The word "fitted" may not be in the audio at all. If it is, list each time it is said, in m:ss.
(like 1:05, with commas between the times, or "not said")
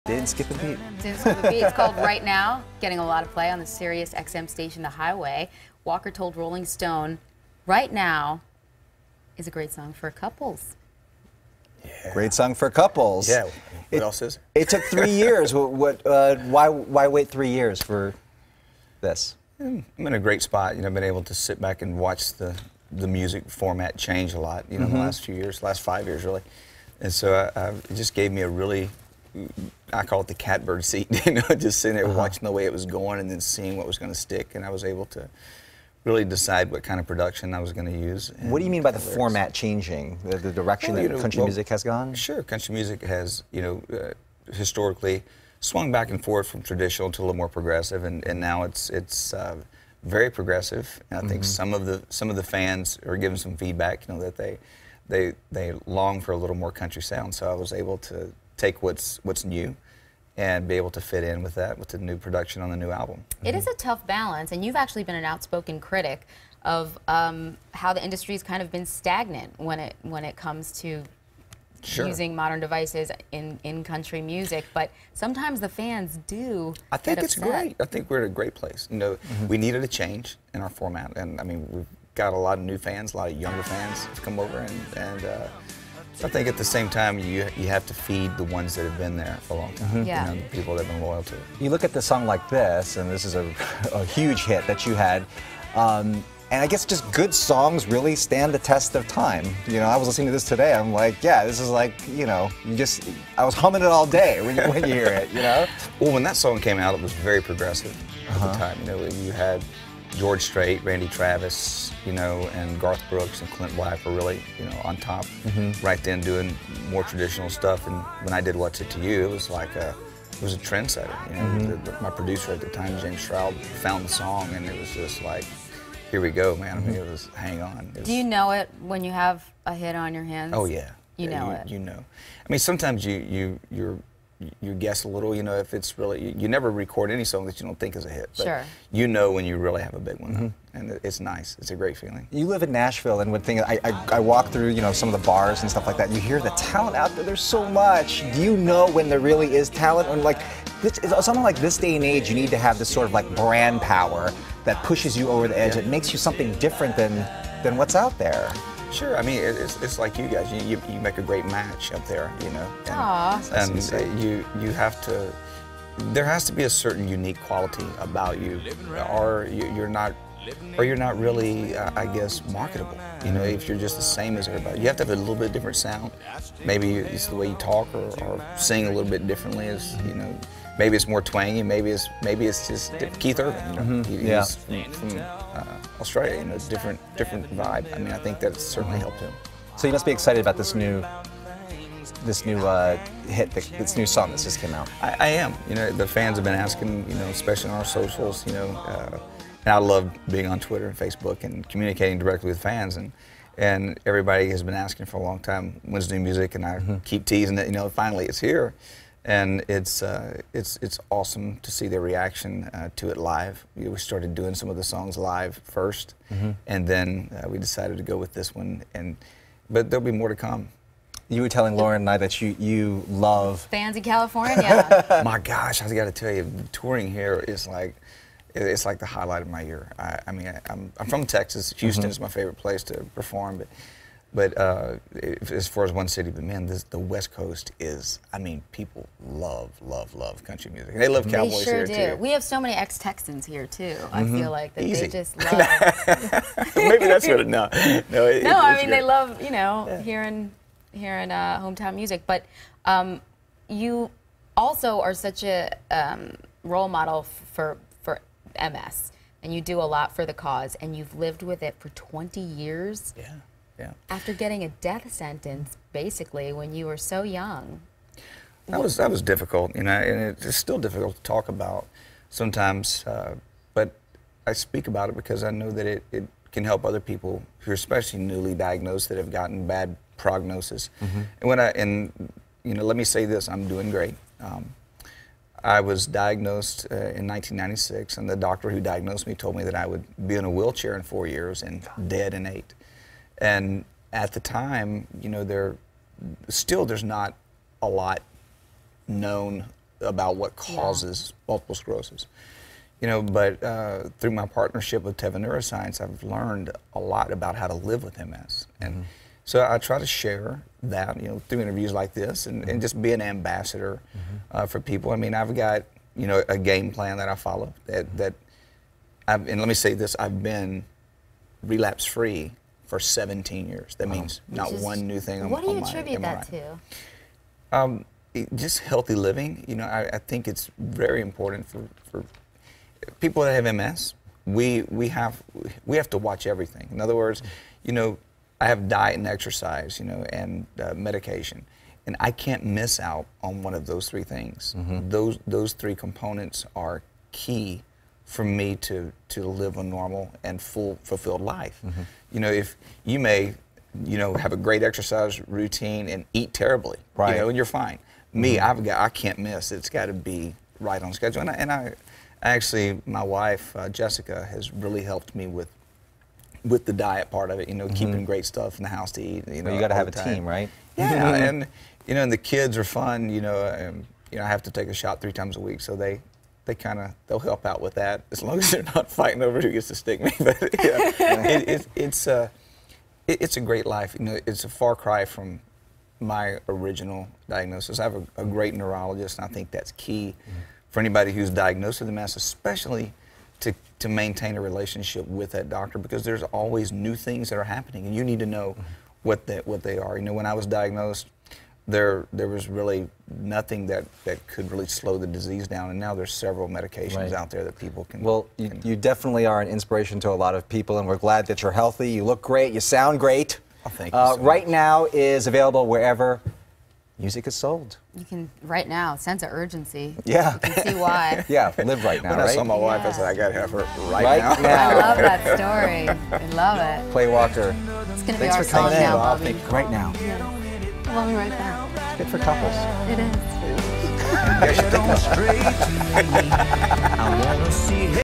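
not said.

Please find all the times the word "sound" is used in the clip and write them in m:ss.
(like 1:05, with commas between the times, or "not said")
0:57, 2:55, 6:52.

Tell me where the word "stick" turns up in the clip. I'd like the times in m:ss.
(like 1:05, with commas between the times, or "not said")
0:34, 6:19.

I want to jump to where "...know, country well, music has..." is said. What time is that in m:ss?
0:41.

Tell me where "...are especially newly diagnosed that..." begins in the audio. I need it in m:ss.
4:37.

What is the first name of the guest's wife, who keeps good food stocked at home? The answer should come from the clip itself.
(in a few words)
Jessica.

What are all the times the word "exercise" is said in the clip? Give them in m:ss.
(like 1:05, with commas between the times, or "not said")
5:39, 5:54.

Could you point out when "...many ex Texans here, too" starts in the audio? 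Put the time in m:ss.
4:02.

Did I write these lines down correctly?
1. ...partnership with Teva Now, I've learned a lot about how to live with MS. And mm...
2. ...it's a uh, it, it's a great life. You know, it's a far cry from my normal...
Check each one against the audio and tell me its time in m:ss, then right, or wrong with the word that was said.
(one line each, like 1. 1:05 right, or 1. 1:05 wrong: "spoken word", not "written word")
1. 5:04 wrong: "Neuroscience", not "Now"
2. 6:21 wrong: "original", not "normal".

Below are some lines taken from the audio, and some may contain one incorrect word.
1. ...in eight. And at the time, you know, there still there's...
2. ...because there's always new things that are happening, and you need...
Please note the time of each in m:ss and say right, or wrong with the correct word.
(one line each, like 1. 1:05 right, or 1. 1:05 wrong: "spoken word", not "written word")
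1. 4:52 right
2. 6:35 right.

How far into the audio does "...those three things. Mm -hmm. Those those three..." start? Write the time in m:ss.
5:43.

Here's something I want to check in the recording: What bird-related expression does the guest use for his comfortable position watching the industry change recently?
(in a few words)
catbird seat.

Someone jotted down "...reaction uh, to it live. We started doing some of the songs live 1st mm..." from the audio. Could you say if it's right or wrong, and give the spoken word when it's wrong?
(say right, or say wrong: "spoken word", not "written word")
right.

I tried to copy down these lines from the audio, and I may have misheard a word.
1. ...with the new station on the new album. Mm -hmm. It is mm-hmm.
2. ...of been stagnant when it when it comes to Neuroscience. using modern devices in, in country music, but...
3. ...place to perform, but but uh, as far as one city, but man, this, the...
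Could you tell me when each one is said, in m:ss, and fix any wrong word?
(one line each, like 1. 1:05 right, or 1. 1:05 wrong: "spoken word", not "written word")
1. 1:01 wrong: "production", not "station"
2. 1:08 wrong: "Sure", not "Neuroscience"
3. 3:52 right.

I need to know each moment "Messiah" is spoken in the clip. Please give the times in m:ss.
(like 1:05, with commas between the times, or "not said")
not said.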